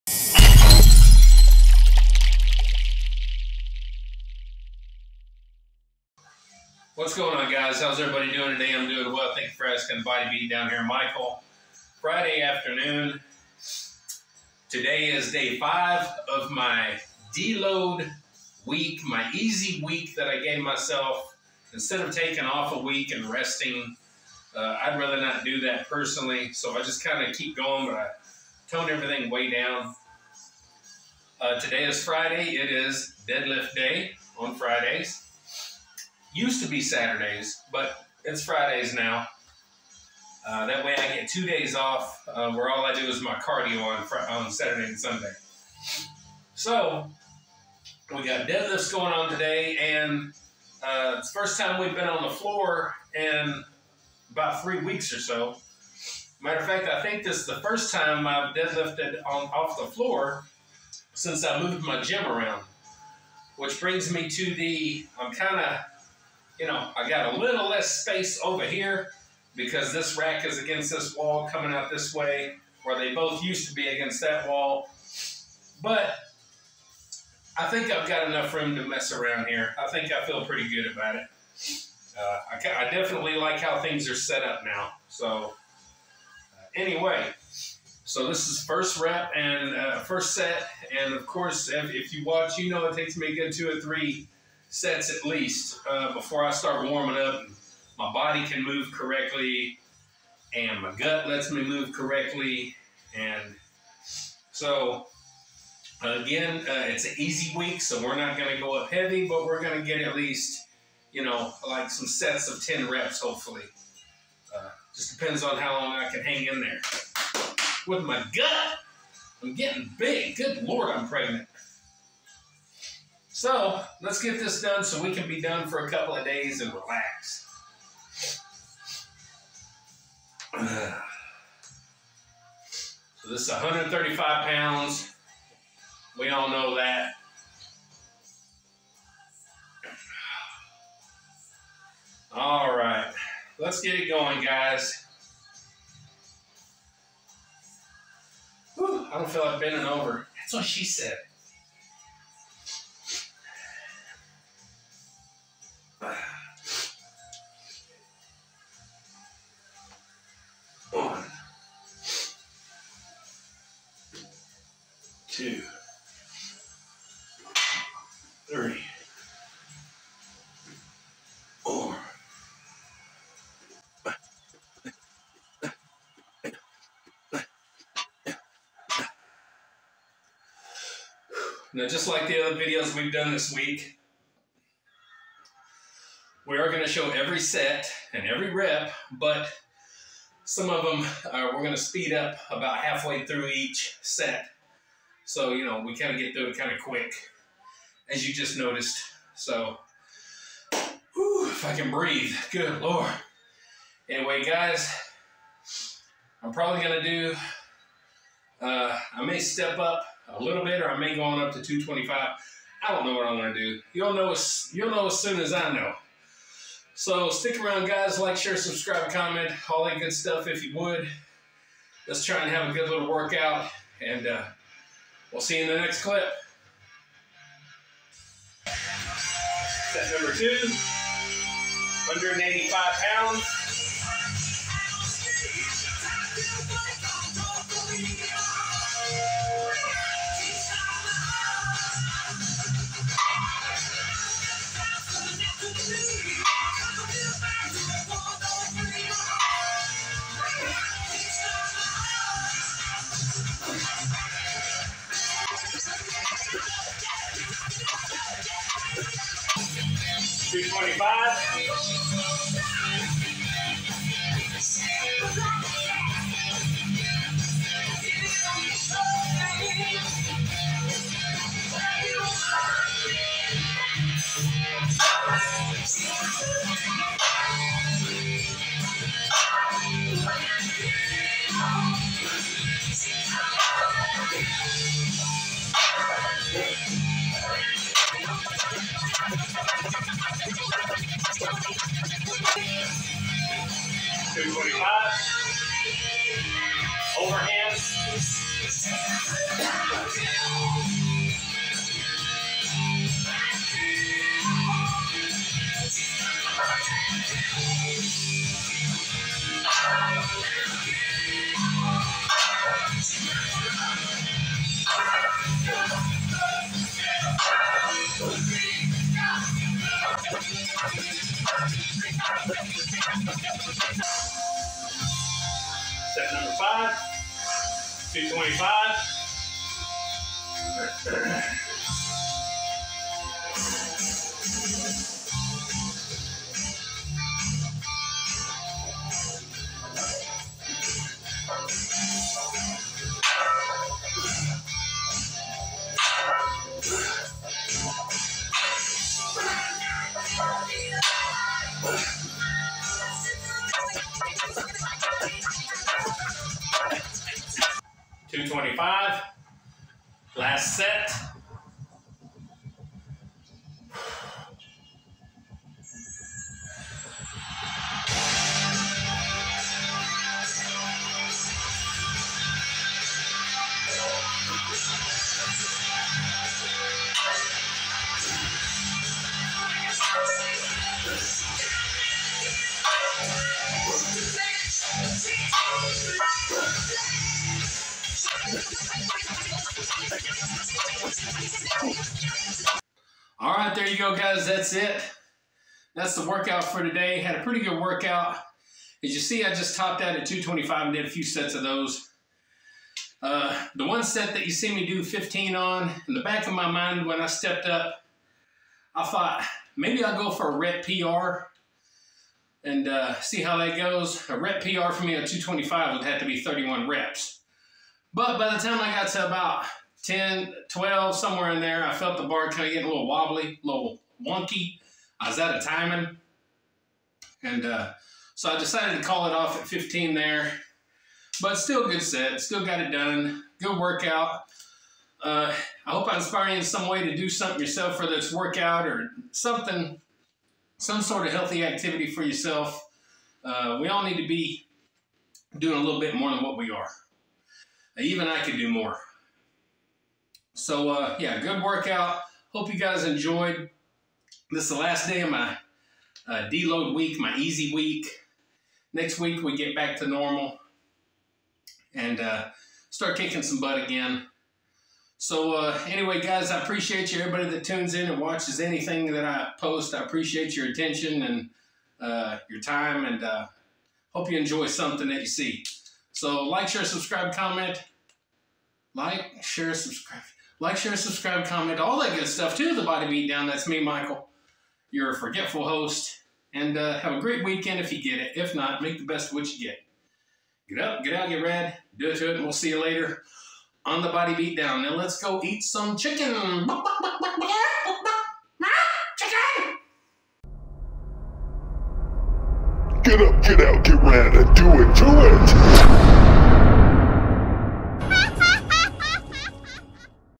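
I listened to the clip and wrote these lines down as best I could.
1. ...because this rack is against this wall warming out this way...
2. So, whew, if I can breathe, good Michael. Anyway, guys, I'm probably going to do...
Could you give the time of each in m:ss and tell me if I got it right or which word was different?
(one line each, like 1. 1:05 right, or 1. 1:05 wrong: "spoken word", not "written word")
1. 1:09 wrong: "coming", not "warming"
2. 3:19 wrong: "Lord", not "Michael".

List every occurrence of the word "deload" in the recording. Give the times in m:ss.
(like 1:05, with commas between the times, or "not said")
0:17, 7:36.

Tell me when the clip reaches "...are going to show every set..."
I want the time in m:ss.
3:06.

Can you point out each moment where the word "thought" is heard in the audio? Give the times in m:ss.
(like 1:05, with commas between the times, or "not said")
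6:49.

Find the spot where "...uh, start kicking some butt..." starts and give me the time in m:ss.
7:42.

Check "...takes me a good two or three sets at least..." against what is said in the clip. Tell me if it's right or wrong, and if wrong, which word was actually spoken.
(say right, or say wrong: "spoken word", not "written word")
right.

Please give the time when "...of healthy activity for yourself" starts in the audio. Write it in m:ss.
7:21.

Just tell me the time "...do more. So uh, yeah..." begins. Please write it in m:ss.
7:28.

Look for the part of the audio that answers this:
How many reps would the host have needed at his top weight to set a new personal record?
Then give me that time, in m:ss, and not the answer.
6:56.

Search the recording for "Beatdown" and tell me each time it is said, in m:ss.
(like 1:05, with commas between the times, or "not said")
0:10, 8:03, 8:14.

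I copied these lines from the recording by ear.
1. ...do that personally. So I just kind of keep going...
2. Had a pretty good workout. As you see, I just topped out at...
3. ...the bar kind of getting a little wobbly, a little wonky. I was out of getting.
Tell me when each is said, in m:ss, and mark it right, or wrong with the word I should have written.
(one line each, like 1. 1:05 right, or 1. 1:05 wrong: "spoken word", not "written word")
1. 0:25 right
2. 6:37 right
3. 7:02 wrong: "timing", not "getting".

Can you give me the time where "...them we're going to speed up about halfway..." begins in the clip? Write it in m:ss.
3:10.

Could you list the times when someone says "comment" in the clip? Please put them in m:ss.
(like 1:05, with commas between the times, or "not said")
3:39, 7:57, 8:01.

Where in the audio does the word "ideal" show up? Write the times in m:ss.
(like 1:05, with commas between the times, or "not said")
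not said.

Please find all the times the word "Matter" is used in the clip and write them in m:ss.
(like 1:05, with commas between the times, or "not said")
0:56.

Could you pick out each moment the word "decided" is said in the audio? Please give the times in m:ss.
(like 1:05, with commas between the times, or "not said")
7:08.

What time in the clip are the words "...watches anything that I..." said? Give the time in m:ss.
7:48.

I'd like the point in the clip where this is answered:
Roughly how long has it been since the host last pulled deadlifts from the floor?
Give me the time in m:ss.
0:54.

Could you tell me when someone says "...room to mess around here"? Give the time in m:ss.
1:18.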